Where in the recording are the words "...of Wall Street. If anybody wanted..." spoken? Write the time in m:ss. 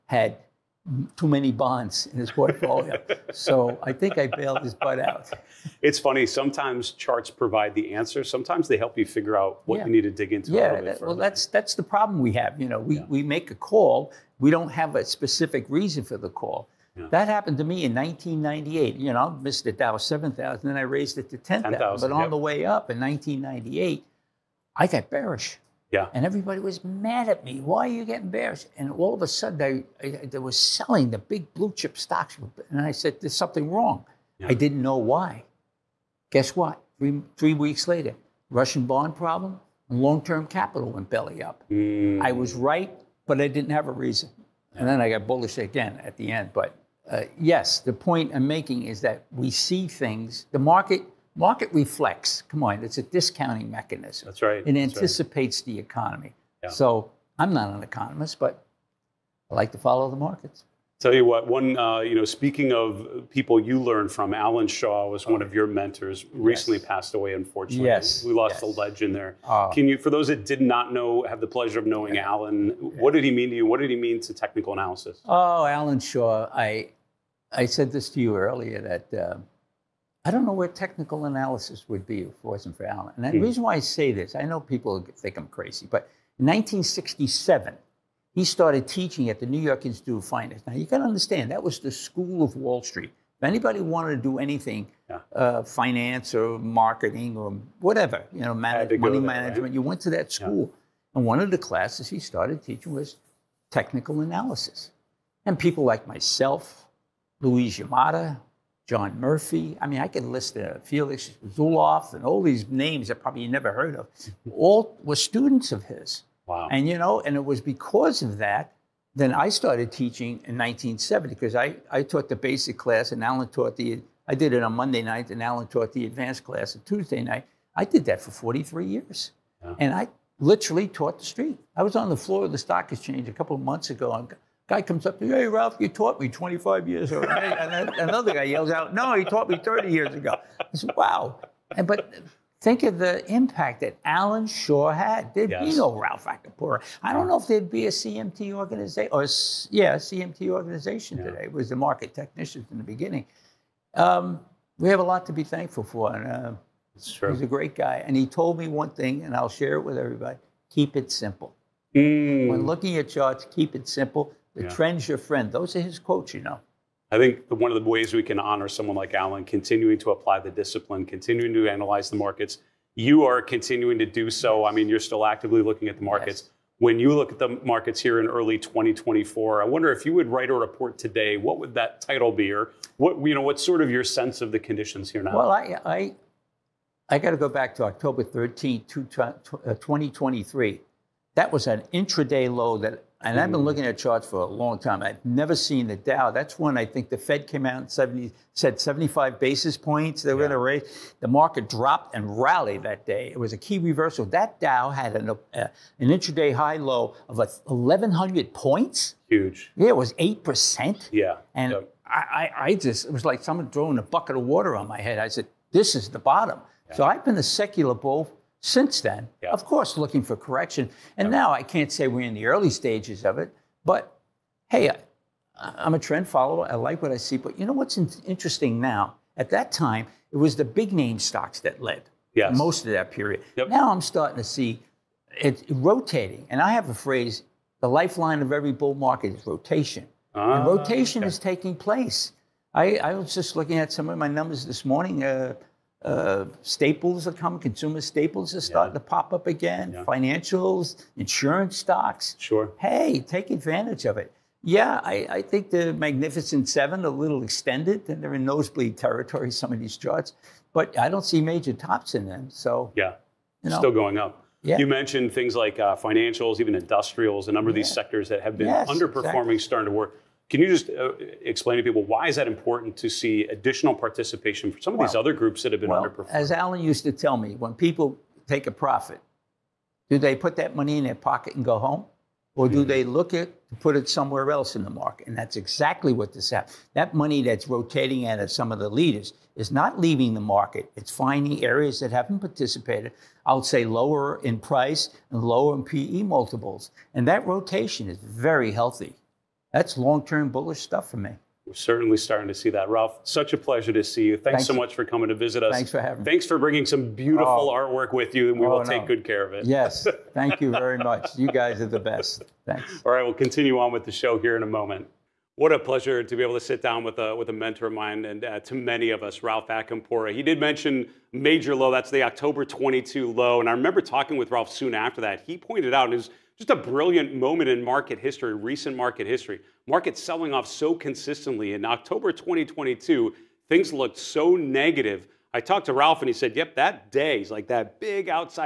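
1:32.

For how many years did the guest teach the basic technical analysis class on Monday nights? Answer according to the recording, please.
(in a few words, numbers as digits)
43.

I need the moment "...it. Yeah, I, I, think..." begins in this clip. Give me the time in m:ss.
4:14.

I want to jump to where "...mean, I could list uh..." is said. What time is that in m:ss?
1:49.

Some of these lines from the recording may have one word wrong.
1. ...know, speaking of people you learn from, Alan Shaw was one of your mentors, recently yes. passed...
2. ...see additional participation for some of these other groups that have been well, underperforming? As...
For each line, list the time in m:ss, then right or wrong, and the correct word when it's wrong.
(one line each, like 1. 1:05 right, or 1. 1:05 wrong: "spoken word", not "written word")
1. 1:02 right
2. 4:33 right.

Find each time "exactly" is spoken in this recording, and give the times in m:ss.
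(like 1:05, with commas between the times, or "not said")
4:29, 4:45.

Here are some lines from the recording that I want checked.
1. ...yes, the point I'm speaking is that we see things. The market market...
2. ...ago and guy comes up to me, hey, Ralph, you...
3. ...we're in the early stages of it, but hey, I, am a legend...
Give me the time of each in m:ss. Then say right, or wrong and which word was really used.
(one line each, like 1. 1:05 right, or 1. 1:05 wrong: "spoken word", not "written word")
1. 0:47 wrong: "making", not "speaking"
2. 2:13 right
3. 3:42 wrong: "trend", not "legend".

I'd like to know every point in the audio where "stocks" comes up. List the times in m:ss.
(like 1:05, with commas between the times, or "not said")
0:31, 2:12, 3:51, 4:11.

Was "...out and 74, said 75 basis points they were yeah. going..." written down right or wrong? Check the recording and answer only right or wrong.
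wrong.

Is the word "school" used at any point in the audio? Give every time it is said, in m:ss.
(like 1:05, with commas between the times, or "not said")
1:31, 1:40.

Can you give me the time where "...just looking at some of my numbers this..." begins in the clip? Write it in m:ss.
4:03.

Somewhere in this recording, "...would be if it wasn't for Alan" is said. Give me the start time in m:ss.
1:21.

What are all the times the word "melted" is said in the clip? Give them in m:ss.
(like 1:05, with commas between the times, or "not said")
not said.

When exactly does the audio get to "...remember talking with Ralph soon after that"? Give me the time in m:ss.
5:23.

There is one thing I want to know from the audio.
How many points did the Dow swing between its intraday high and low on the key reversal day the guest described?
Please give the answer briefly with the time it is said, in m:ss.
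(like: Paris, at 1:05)
1,100, at 3:27.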